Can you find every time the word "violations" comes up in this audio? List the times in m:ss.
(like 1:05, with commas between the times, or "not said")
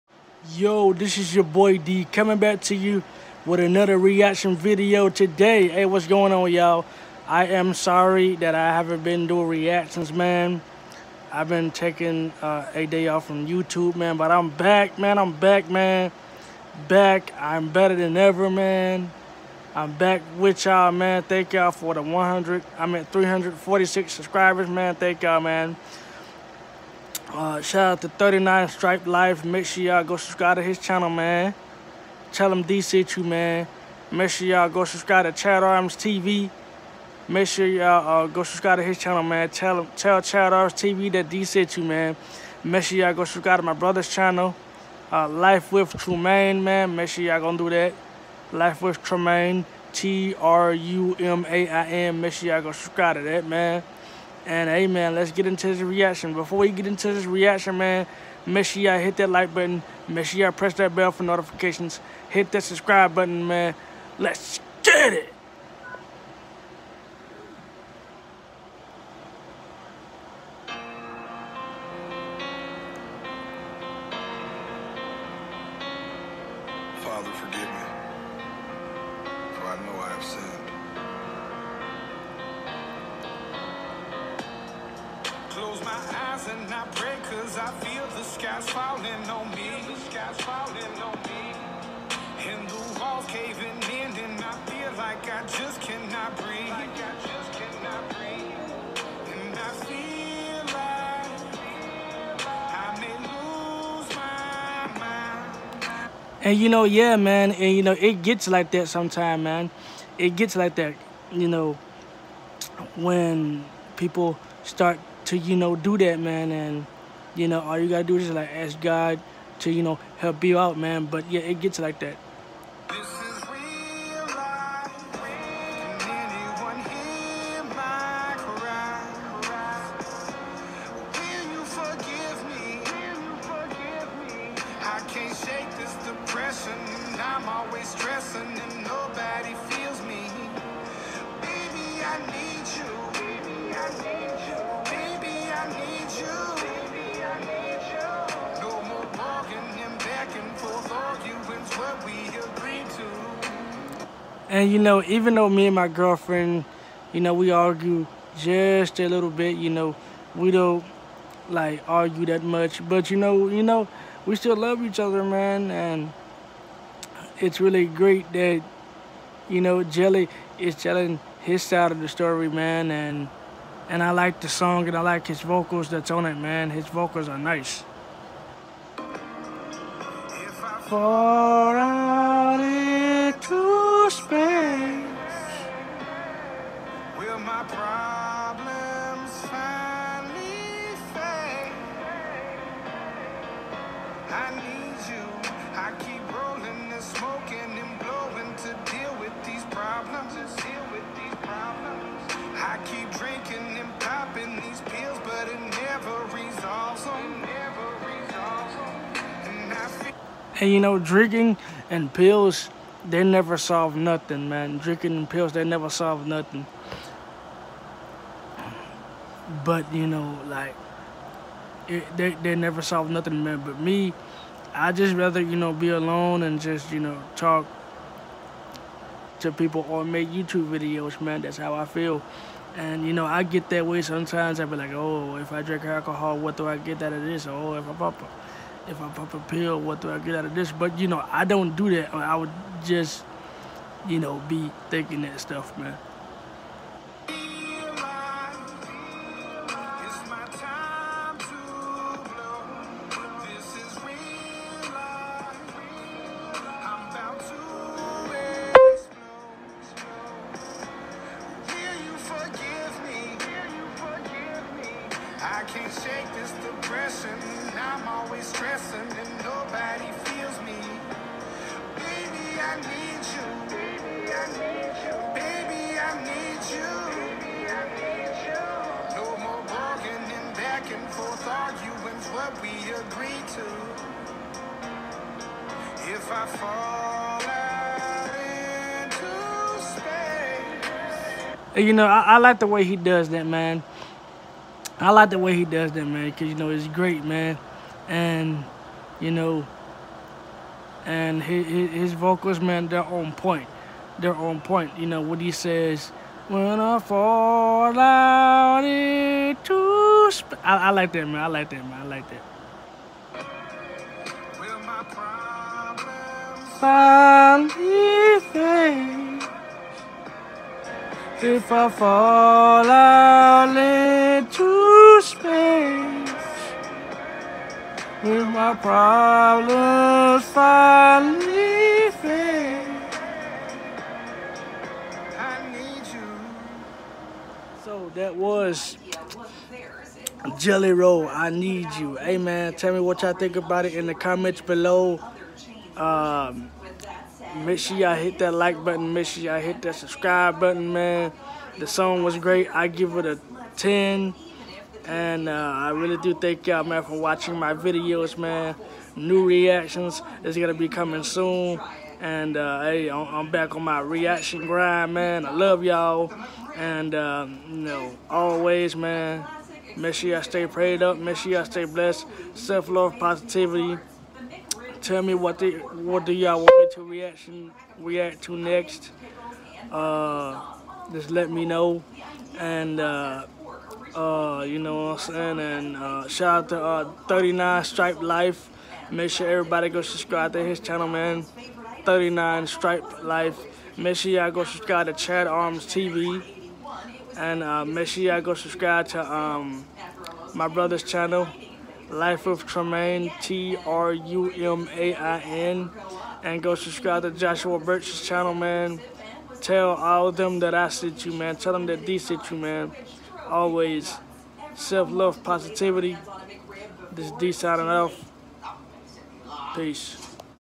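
not said.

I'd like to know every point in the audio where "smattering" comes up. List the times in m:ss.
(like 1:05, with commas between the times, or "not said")
not said.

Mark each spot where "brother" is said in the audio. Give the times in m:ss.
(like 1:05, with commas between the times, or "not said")
0:43, 6:40.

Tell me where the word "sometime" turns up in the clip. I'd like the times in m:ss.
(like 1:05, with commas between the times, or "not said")
1:48, 3:54.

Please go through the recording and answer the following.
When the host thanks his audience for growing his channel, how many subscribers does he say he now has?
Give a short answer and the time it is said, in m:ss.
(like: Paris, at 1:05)
346, at 0:23.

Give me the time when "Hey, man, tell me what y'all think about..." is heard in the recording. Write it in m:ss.
5:42.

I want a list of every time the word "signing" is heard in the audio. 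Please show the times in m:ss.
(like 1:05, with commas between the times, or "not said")
6:57.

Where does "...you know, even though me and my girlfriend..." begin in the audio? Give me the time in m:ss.
2:34.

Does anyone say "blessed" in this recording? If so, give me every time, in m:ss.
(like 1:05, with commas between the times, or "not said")
6:11.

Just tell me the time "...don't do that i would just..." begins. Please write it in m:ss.
4:01.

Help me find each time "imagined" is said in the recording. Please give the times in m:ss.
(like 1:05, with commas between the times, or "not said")
not said.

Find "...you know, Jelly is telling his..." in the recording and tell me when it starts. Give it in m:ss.
2:49.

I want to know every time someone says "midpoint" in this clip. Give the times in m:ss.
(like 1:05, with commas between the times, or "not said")
not said.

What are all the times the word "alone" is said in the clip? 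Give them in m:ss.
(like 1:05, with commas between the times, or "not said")
3:45.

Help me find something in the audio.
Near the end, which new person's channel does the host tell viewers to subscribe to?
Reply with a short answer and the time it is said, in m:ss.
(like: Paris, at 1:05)
Joshua Birch, at 6:47.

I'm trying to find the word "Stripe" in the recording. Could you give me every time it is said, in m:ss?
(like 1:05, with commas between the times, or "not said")
0:28, 6:27, 6:32.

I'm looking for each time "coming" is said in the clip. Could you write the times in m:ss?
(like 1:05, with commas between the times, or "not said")
0:02, 6:00.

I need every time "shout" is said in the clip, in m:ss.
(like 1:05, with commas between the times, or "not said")
0:27, 6:26.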